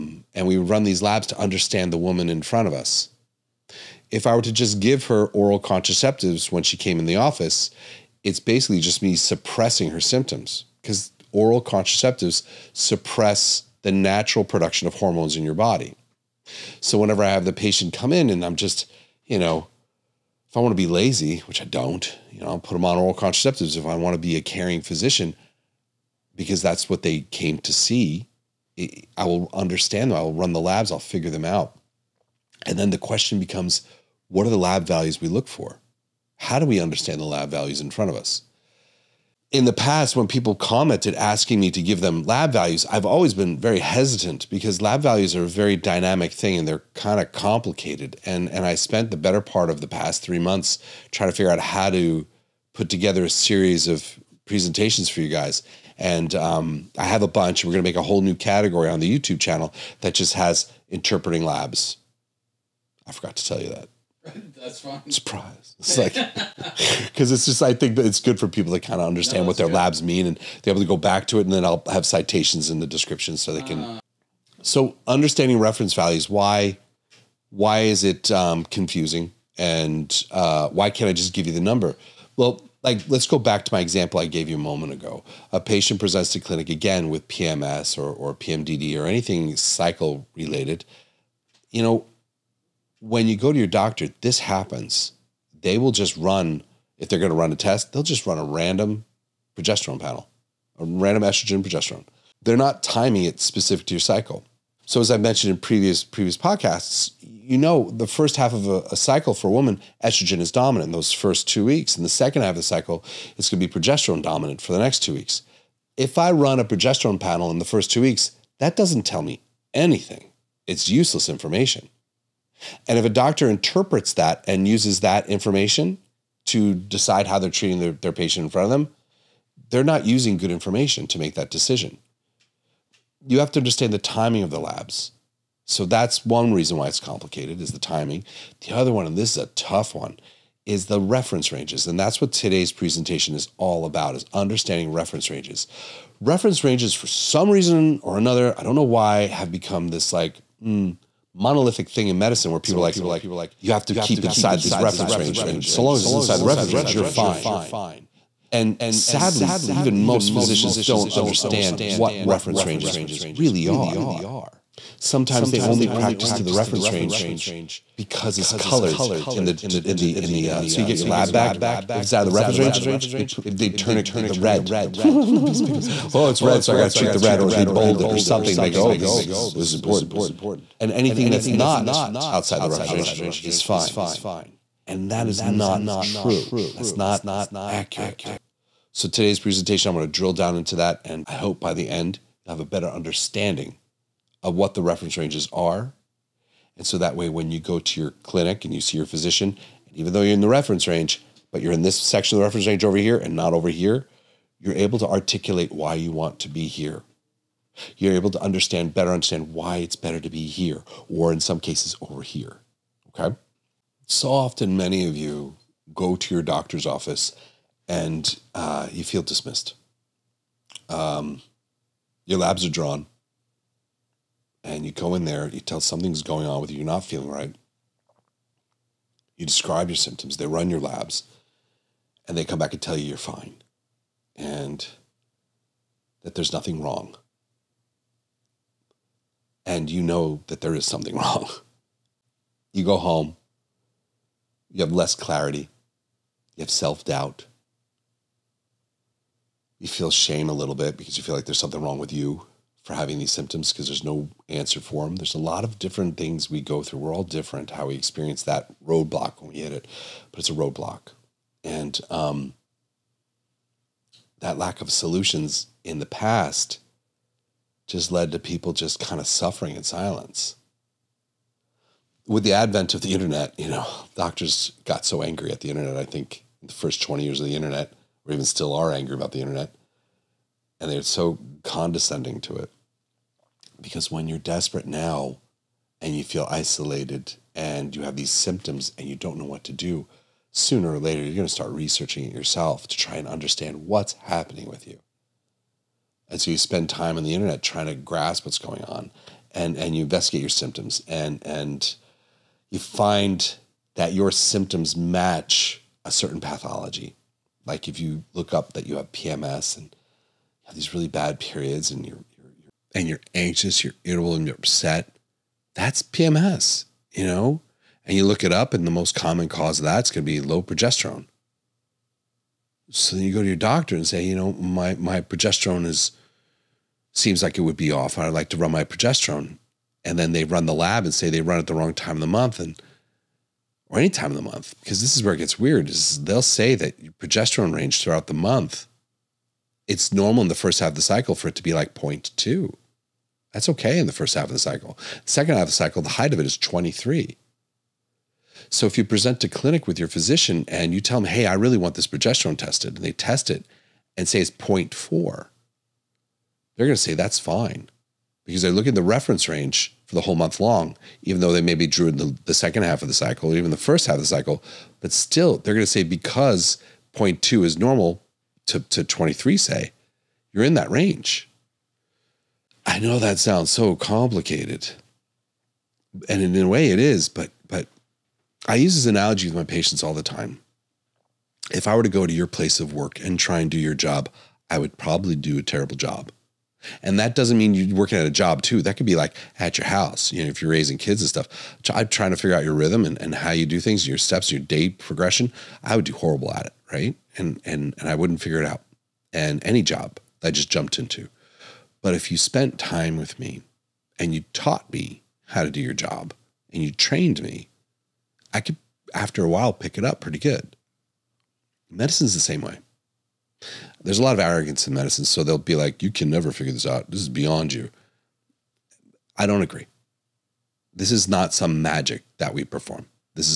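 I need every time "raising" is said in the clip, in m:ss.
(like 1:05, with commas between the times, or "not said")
6:30.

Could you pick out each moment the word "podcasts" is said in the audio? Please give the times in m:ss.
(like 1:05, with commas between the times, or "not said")
1:46.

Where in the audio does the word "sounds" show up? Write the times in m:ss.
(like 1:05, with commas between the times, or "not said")
6:13.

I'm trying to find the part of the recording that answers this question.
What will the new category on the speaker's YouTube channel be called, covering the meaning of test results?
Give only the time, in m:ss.
1:00.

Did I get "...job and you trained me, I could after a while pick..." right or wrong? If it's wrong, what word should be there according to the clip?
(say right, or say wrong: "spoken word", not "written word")
right.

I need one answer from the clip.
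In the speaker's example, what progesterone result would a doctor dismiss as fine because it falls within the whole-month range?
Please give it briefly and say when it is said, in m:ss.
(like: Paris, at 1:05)
0.4, at 5:54.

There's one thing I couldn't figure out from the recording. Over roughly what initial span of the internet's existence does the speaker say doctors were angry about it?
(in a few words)
20 years.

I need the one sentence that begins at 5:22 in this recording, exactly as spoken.
So then you go to your doctor and say, you know, my, my progesterone is – seems like it would be off.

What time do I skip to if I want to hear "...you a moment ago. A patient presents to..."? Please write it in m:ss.
1:24.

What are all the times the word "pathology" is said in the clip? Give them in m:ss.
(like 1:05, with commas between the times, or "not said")
5:06.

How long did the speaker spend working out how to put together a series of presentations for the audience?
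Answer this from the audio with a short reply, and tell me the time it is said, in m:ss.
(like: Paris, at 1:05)
three months, at 0:50.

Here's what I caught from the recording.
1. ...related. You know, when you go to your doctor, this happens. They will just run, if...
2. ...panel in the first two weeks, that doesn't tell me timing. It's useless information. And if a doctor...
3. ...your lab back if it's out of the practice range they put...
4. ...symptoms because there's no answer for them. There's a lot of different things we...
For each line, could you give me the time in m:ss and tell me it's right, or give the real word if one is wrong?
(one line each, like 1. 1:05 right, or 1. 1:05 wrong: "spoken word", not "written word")
1. 1:30 right
2. 1:57 wrong: "anything", not "timing"
3. 2:50 wrong: "reference", not "practice"
4. 4:13 right.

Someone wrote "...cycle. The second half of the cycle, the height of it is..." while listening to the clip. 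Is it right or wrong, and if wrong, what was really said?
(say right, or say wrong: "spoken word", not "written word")
right.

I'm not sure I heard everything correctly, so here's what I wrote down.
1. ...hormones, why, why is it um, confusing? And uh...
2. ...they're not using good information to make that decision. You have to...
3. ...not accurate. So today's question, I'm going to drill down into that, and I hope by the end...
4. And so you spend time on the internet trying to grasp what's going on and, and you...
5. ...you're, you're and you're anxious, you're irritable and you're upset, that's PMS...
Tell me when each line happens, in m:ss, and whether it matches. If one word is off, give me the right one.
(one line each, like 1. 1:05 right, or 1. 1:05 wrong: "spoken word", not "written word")
1. 1:15 wrong: "values", not "hormones"
2. 2:09 right
3. 3:06 wrong: "presentation", not "question"
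4. 4:56 right
5. 5:12 right.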